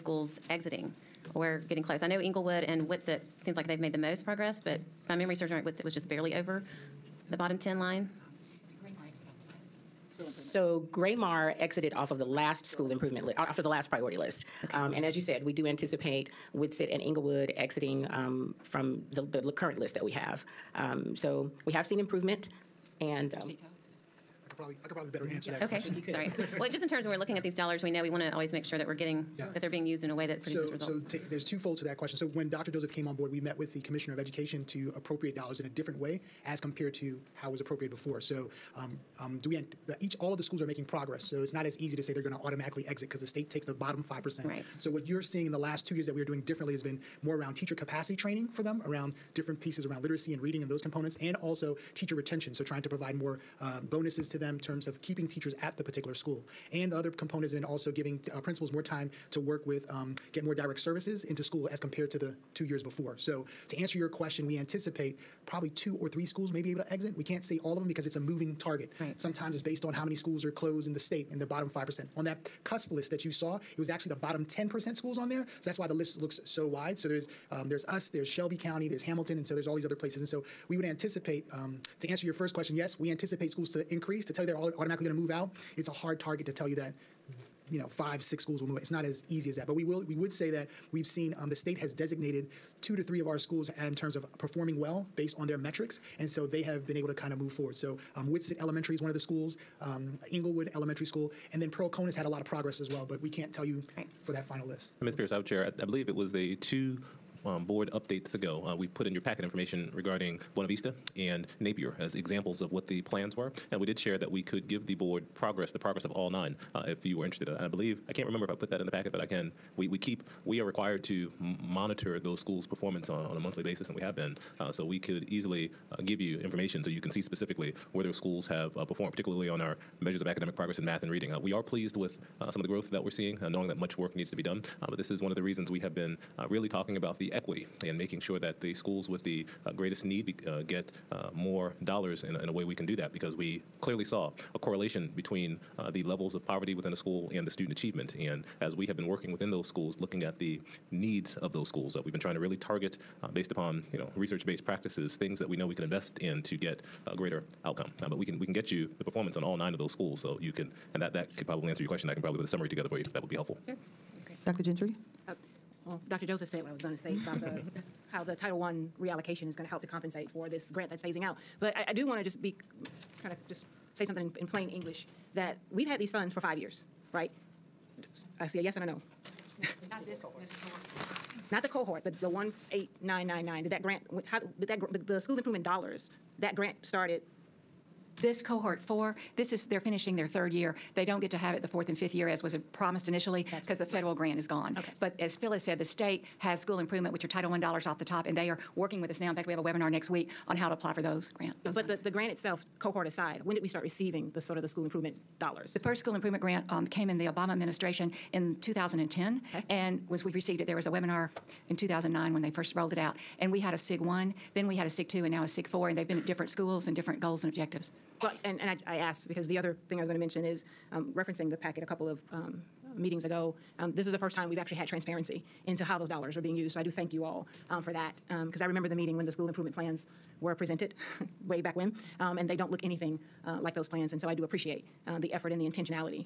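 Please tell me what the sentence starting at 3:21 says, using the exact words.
Those but the, the grant itself, cohort aside, when did we start receiving the sort of the school improvement dollars.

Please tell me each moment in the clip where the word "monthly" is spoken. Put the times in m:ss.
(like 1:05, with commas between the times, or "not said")
2:03.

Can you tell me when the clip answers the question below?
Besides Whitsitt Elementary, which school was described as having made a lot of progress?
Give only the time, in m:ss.
1:41.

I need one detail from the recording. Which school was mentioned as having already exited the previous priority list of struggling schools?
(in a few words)
Gra-Mar.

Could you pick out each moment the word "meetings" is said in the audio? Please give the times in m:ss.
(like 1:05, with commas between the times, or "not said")
3:42, 3:48.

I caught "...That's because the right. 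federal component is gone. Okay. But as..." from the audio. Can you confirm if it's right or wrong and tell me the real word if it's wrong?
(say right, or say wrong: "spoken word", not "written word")
wrong: "grant", not "component".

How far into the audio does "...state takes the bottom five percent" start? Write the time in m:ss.
0:43.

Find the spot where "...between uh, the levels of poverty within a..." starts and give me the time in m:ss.
2:25.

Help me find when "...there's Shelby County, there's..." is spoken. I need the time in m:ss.
1:18.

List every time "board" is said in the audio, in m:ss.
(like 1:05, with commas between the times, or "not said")
0:33, 1:47, 1:54.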